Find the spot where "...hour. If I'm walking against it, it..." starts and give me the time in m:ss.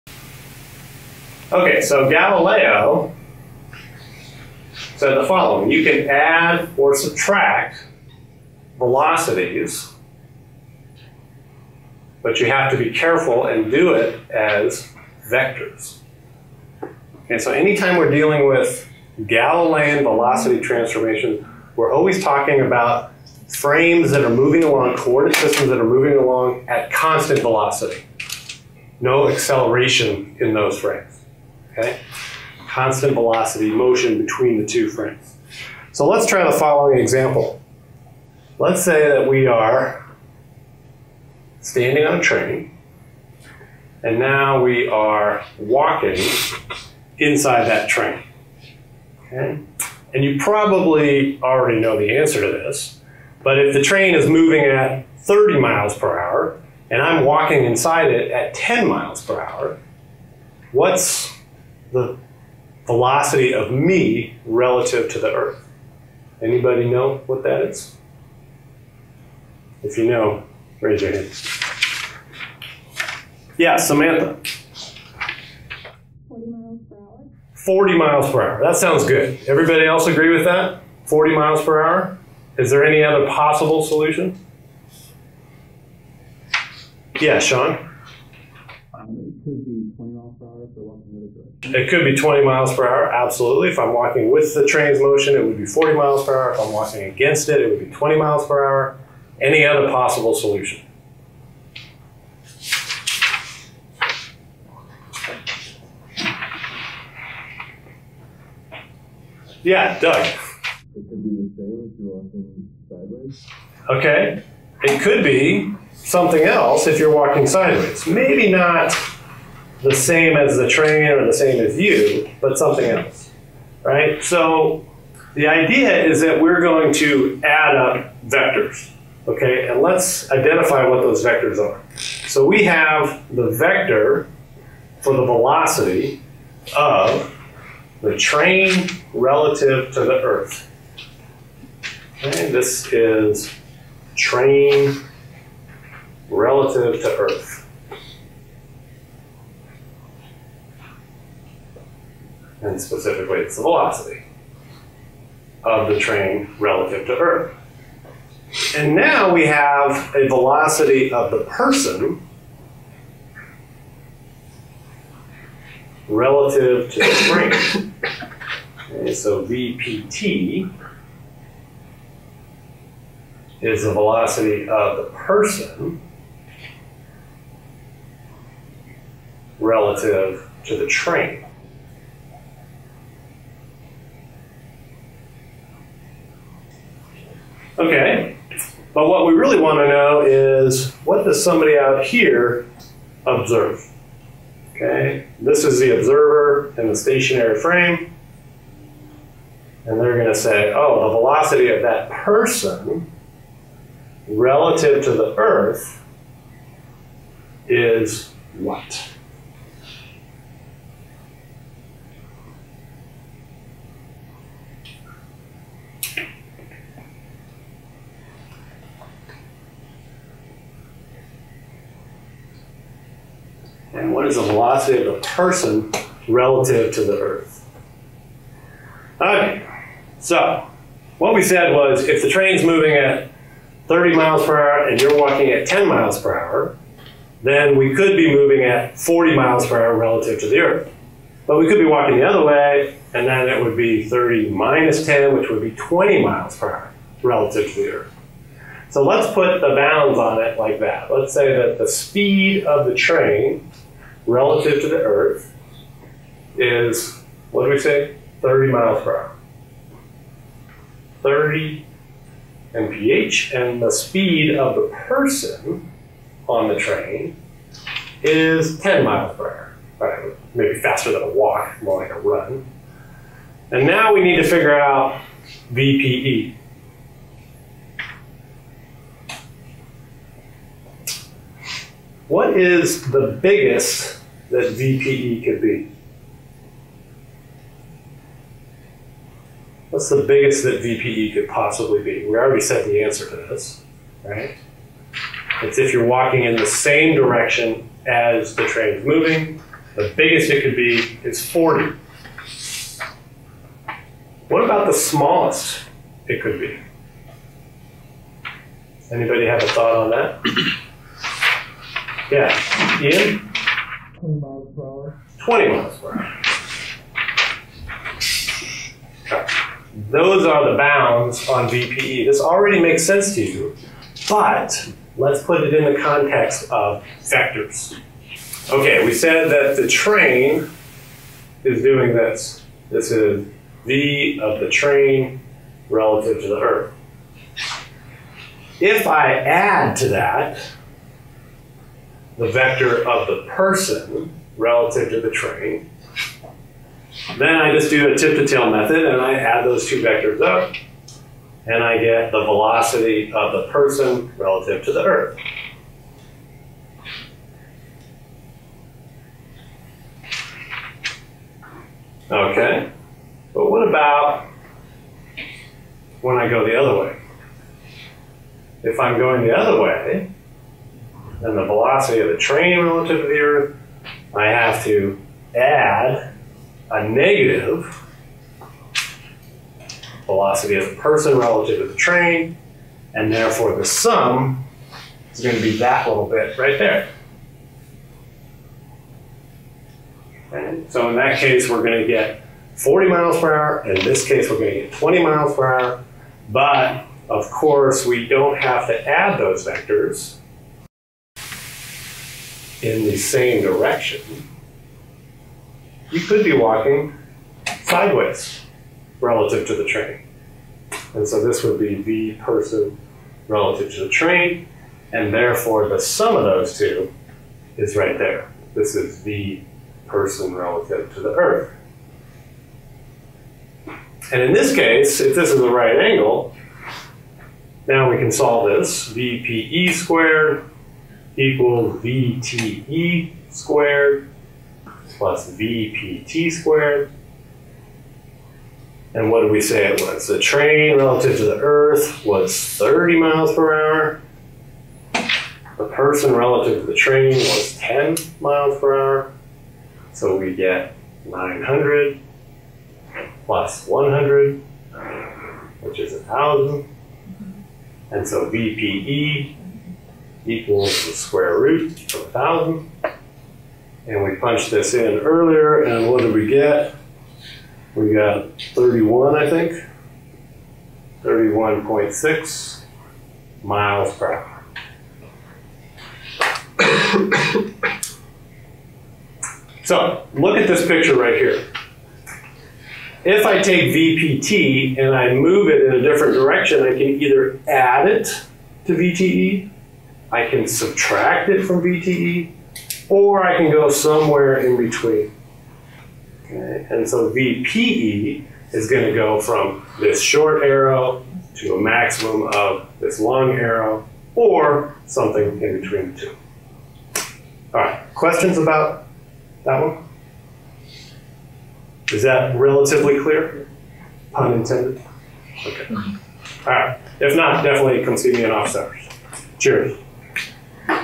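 1:36.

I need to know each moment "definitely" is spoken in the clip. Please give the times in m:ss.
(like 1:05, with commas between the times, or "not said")
8:37.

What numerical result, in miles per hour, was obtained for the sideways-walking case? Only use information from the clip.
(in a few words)
31.6.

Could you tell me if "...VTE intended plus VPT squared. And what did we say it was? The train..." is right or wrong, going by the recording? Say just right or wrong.
wrong.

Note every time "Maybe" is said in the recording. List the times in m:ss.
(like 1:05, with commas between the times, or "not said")
1:58, 4:30.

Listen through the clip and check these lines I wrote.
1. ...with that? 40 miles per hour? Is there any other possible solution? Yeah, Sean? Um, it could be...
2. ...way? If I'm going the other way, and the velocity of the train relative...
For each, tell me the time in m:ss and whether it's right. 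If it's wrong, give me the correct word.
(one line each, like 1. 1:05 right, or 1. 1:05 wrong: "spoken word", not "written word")
1. 1:20 right
2. 6:06 right.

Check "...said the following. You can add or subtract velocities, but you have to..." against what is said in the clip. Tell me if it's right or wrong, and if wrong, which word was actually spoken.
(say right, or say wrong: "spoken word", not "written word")
right.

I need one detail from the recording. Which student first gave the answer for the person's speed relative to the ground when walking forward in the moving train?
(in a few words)
Samantha.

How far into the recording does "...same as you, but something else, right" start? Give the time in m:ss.
2:01.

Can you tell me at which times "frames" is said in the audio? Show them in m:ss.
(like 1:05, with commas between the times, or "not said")
0:23, 0:30, 0:34, 3:17.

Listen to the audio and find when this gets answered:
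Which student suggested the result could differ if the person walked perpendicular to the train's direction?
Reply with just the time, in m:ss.
1:49.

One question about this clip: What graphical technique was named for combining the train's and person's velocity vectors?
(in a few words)
tip to tail method.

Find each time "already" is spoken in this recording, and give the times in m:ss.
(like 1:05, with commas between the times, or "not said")
0:51, 4:52, 5:22.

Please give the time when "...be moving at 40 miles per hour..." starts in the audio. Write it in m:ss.
3:58.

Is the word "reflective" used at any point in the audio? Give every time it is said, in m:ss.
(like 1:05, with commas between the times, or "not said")
not said.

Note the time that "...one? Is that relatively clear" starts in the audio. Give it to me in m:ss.
8:29.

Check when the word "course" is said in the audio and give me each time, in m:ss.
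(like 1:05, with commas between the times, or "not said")
6:37.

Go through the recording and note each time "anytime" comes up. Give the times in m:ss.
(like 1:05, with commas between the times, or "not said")
0:17.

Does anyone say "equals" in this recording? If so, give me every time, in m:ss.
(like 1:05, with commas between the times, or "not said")
7:11, 7:40.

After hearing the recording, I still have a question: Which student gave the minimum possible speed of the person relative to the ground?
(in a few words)
Ian.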